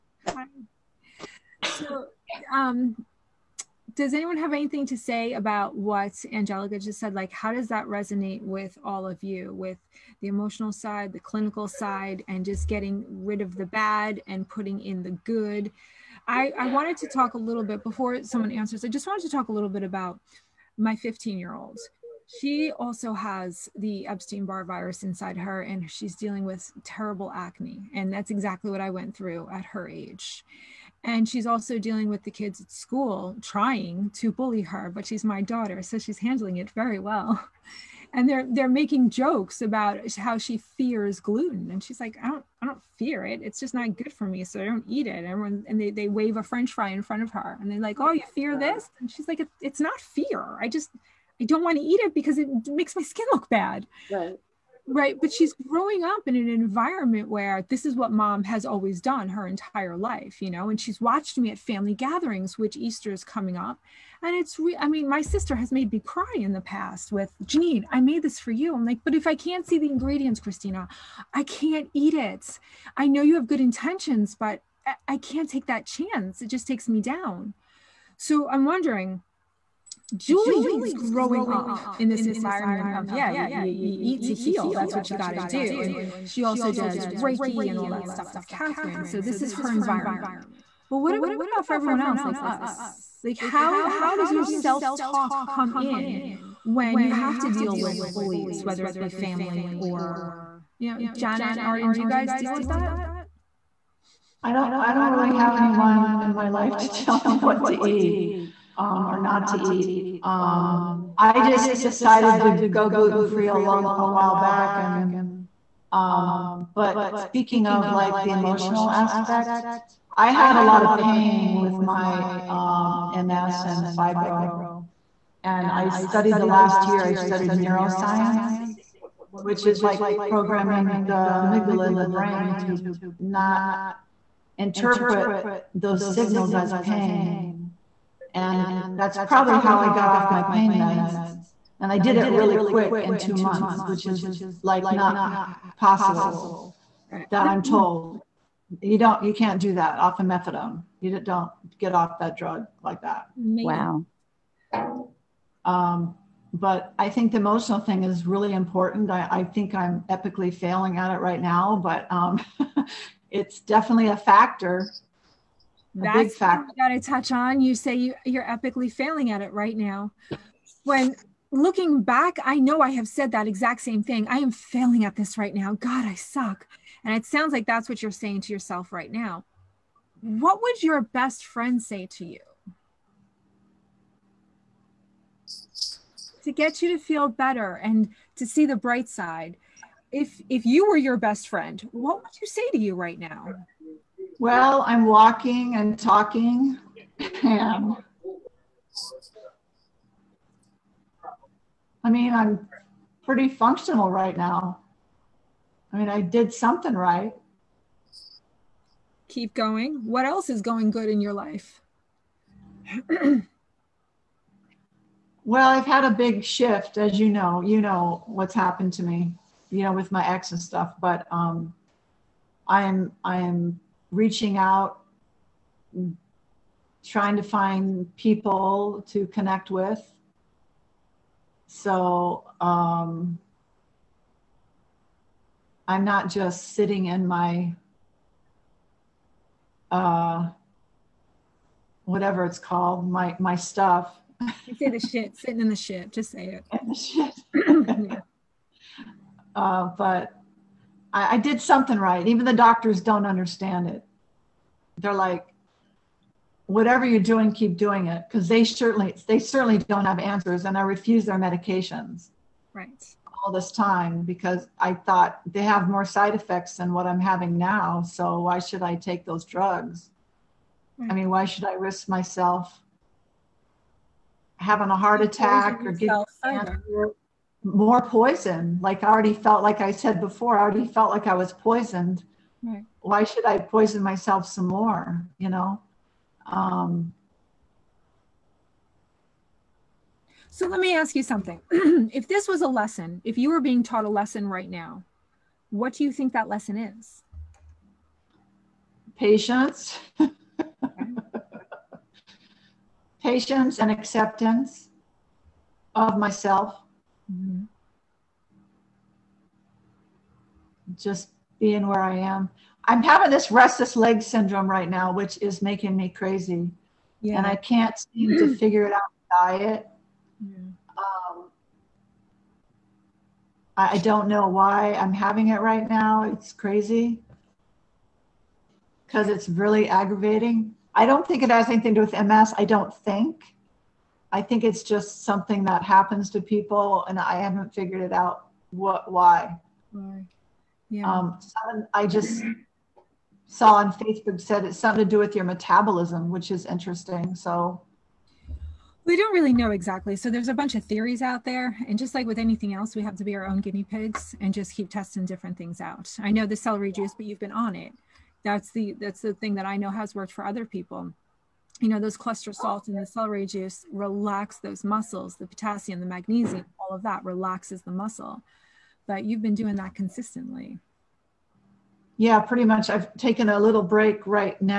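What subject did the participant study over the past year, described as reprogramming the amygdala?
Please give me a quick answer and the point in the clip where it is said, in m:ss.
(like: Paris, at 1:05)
neuroscience, at 2:07.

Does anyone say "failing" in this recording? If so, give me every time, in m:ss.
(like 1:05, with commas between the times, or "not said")
2:40, 2:48, 2:54.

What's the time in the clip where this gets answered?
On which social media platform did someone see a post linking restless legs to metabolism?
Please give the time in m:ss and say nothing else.
5:43.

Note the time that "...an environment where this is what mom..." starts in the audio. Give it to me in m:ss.
0:56.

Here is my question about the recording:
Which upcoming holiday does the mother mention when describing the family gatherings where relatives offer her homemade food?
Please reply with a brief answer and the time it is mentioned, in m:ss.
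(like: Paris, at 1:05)
Easter, at 1:02.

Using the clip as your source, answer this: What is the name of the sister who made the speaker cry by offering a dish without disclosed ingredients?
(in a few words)
Christina.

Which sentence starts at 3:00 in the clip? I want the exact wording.
What would your best friend say to you?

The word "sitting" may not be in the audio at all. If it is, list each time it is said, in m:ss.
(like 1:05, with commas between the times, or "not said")
3:56, 4:05.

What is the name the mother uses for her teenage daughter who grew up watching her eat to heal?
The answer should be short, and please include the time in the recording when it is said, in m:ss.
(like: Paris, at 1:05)
Julie, at 1:20.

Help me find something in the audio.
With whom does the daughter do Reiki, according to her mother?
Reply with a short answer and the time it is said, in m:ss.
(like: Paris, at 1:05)
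Catherine, at 1:28.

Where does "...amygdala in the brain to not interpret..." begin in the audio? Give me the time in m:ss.
2:11.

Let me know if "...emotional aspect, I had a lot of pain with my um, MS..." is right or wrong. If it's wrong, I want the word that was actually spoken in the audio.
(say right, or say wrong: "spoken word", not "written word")
right.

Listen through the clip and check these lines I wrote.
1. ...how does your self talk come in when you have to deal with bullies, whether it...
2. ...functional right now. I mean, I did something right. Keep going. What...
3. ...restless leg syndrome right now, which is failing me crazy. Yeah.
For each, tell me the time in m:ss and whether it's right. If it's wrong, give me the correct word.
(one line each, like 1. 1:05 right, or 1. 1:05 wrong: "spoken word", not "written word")
1. 1:33 right
2. 3:23 right
3. 5:13 wrong: "making", not "failing".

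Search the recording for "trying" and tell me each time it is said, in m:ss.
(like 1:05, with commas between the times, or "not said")
0:33, 3:47.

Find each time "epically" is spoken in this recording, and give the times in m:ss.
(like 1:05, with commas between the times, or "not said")
2:40, 2:48.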